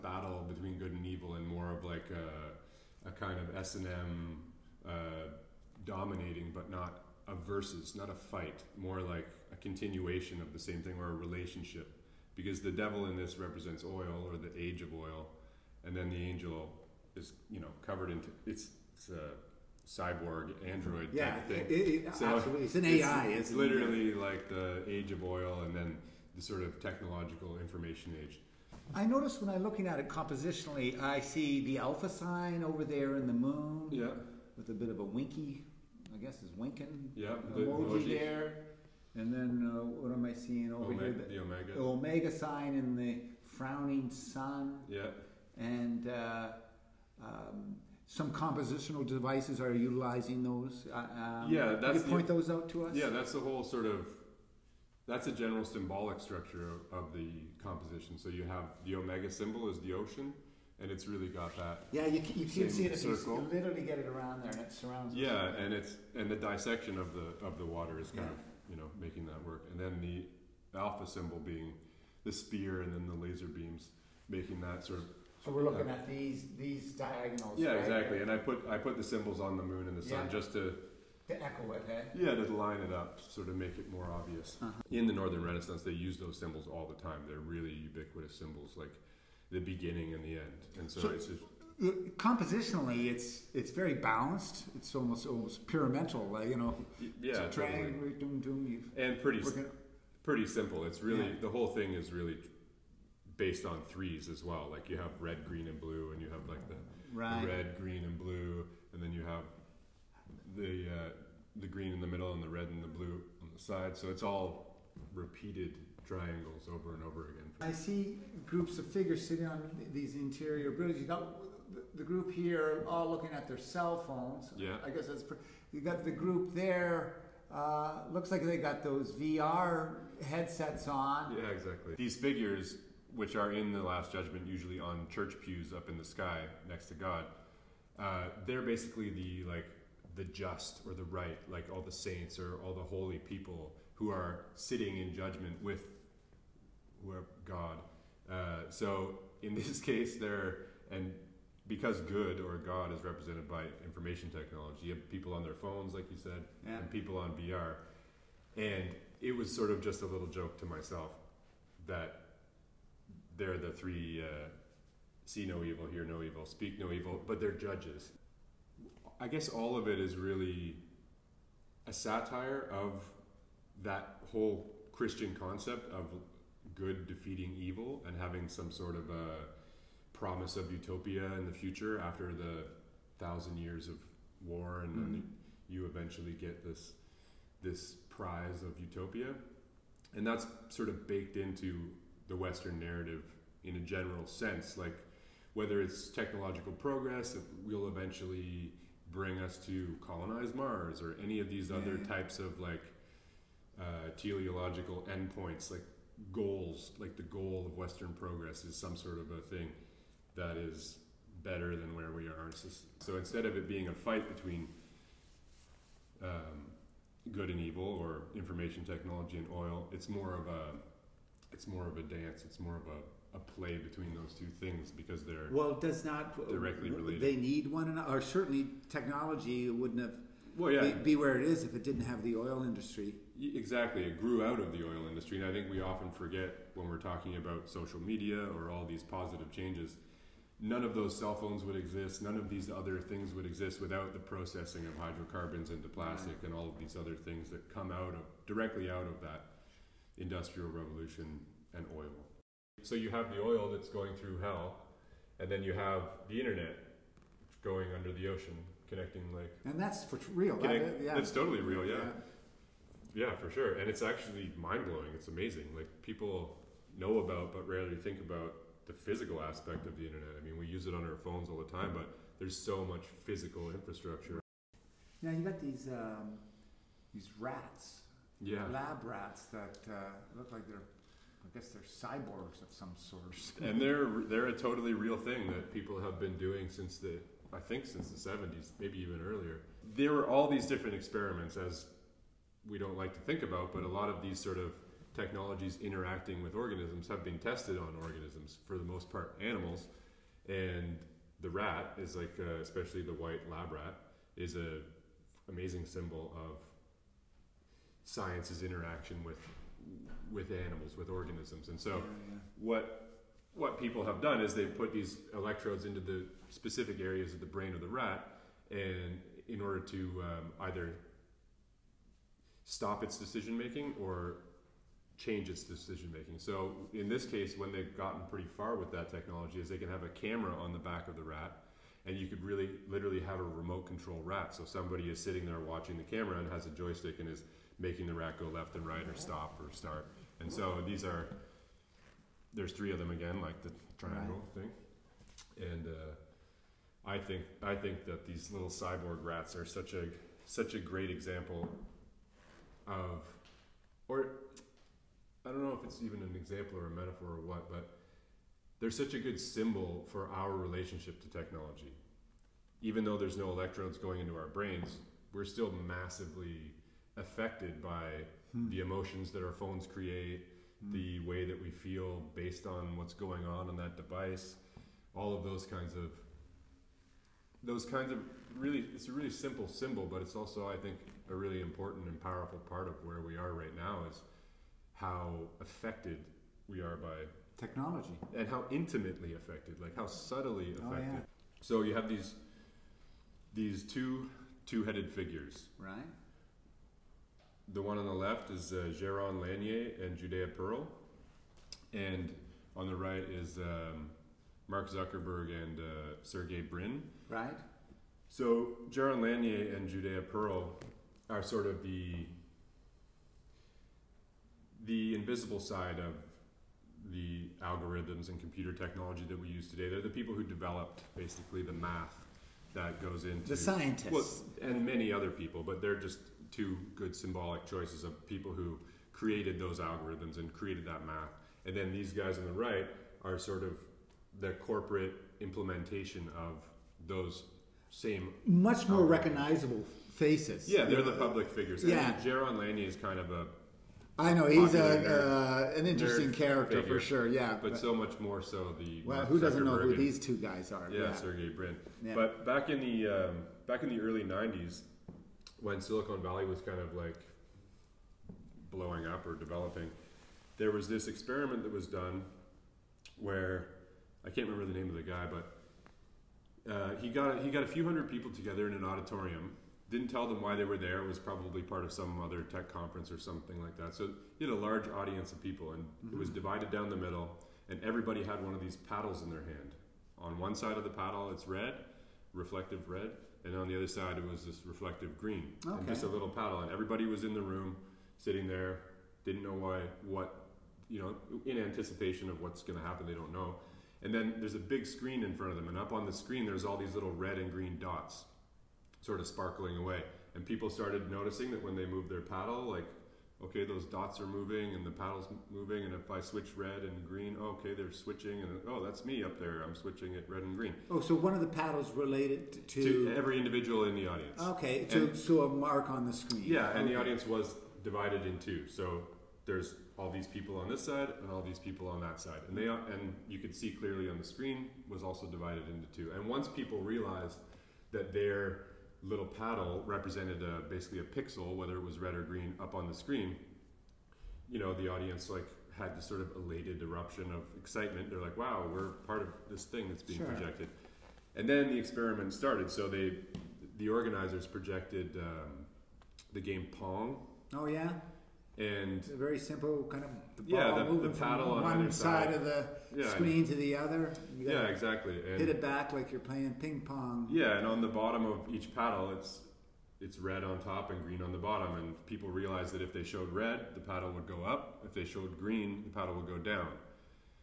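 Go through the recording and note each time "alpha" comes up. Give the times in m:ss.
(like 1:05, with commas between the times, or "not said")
0:31, 1:10.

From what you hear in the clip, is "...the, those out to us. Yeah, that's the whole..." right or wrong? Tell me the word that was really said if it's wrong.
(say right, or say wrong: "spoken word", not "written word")
right.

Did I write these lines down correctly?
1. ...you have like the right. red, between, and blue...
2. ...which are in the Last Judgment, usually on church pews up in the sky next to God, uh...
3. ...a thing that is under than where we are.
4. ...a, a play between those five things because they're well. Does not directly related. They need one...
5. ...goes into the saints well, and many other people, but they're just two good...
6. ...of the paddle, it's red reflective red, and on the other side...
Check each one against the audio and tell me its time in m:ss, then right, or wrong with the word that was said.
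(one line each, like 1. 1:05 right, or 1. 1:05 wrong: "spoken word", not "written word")
1. 1:46 wrong: "green", not "between"
2. 2:13 right
3. 3:29 wrong: "better", not "under"
4. 3:42 wrong: "two", not "five"
5. 7:03 wrong: "scientists", not "saints"
6. 8:00 right.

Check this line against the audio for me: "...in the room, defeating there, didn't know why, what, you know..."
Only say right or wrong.
wrong.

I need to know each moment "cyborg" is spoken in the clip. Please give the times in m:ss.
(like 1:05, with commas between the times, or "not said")
0:19, 4:41, 5:48.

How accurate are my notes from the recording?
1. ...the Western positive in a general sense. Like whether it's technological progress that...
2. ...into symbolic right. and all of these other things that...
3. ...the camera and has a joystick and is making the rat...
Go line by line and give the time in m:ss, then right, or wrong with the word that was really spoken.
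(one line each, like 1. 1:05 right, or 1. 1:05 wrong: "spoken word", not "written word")
1. 3:12 wrong: "narrative", not "positive"
2. 4:05 wrong: "plastic", not "symbolic"
3. 5:35 right.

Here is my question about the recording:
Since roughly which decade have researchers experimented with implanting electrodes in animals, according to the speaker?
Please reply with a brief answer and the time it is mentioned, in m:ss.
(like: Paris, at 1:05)
1970s, at 4:48.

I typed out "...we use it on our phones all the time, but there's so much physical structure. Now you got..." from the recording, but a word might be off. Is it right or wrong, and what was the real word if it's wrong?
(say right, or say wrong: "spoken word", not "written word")
wrong: "infrastructure", not "structure".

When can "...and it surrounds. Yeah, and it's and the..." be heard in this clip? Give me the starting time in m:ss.
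1:04.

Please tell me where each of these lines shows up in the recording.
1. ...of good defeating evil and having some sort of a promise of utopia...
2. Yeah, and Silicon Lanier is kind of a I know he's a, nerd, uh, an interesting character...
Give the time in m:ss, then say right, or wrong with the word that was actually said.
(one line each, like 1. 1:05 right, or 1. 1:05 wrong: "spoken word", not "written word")
1. 2:55 right
2. 7:21 wrong: "Jaron", not "Silicon".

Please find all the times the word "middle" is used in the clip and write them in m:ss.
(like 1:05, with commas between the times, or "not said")
1:52, 7:56.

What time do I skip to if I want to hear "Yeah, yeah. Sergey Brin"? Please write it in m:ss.
7:30.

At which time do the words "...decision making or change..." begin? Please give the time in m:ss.
5:23.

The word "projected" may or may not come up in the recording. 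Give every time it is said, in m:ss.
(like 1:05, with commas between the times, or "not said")
9:00, 9:04.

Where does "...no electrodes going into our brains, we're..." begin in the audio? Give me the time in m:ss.
6:03.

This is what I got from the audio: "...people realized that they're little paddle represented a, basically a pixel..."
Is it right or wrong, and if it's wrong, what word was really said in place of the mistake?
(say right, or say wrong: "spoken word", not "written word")
right.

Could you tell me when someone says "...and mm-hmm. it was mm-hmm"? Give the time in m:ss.
7:55.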